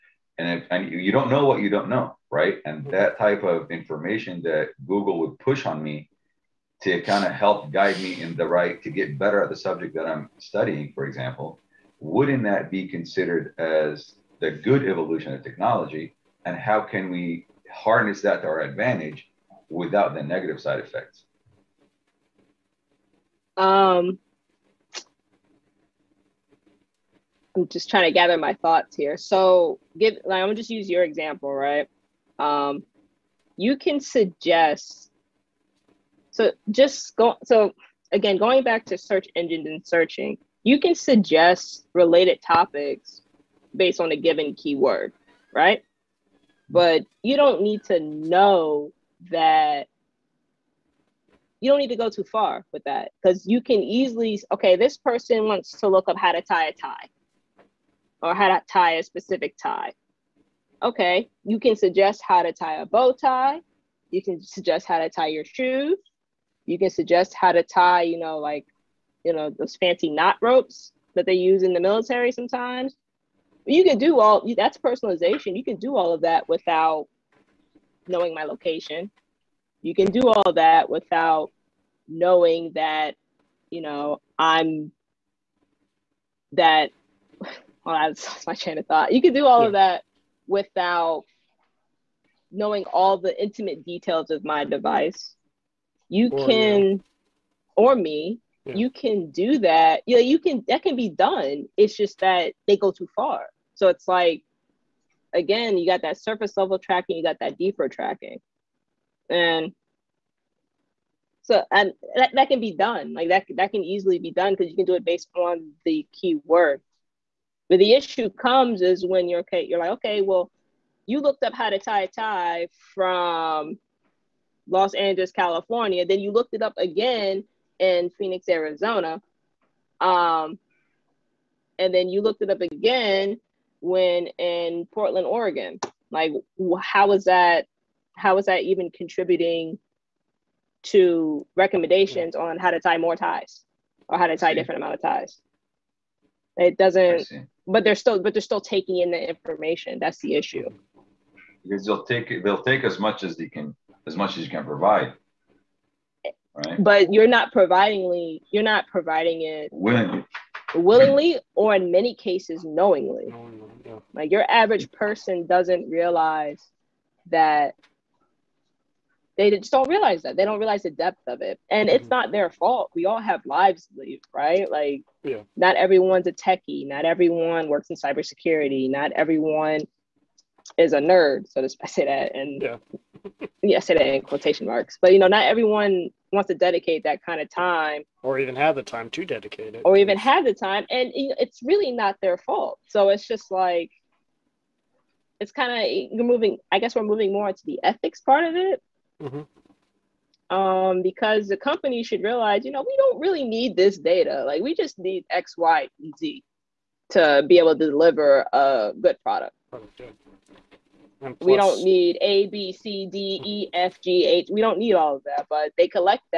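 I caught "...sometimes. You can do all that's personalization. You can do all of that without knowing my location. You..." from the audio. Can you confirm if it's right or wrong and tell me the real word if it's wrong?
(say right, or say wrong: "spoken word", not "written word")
right.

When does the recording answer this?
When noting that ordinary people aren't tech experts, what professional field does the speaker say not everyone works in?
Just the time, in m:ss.
2:57.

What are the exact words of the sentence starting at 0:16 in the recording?
And how can we harness that to our advantage without the negative side effects?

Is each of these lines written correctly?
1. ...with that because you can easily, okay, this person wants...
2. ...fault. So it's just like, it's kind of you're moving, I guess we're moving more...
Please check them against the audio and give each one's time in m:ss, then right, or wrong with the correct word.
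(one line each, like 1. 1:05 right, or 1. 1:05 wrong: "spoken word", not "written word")
1. 0:52 right
2. 3:12 right.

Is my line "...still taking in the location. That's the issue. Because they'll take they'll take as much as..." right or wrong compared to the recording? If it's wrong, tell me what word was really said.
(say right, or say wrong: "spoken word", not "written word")
wrong: "information", not "location".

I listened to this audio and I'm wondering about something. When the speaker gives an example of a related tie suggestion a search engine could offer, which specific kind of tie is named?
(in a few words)
bow tie.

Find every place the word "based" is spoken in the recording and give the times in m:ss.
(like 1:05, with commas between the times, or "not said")
0:43, 1:55.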